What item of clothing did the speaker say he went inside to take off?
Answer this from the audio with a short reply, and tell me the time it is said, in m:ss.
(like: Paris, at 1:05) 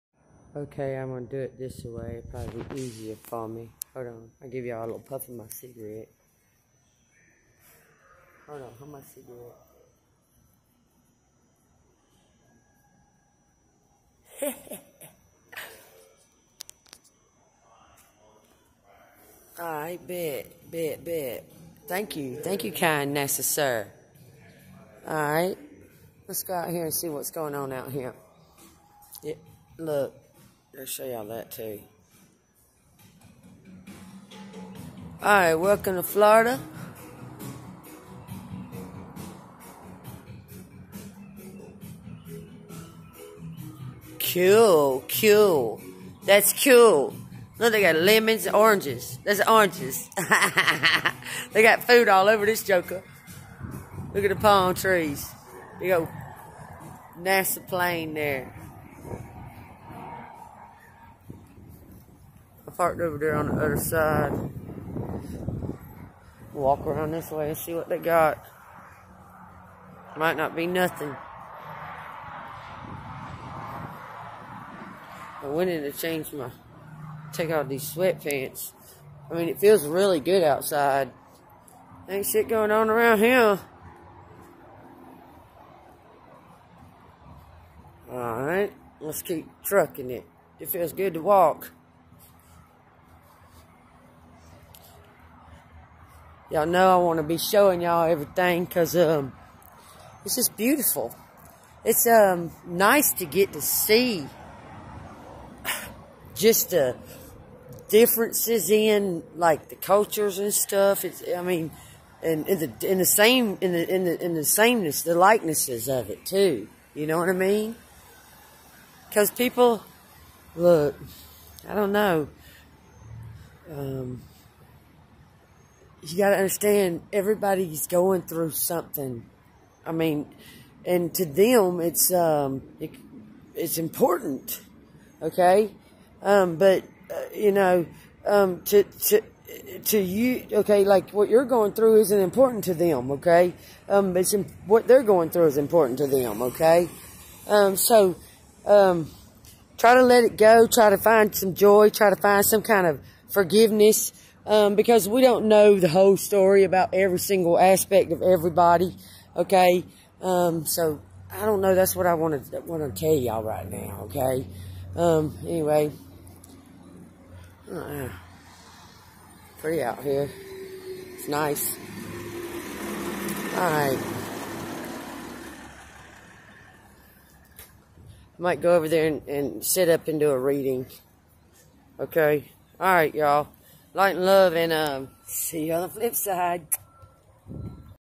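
Sweatpants, at 1:17.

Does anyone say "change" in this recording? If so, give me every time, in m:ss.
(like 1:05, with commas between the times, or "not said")
1:15.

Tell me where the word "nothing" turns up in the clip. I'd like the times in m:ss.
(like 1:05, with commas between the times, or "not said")
1:10.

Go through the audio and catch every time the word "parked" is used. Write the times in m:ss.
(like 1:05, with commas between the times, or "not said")
1:02.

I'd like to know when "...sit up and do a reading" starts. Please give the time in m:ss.
2:59.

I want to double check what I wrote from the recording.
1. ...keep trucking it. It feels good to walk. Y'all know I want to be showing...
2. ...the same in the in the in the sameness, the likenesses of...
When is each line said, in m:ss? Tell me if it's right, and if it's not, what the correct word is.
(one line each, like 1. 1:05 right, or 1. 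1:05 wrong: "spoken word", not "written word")
1. 1:29 right
2. 1:52 right.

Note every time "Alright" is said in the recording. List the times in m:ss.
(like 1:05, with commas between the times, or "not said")
0:35, 1:28.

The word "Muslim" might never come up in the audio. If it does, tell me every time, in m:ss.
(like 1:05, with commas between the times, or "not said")
not said.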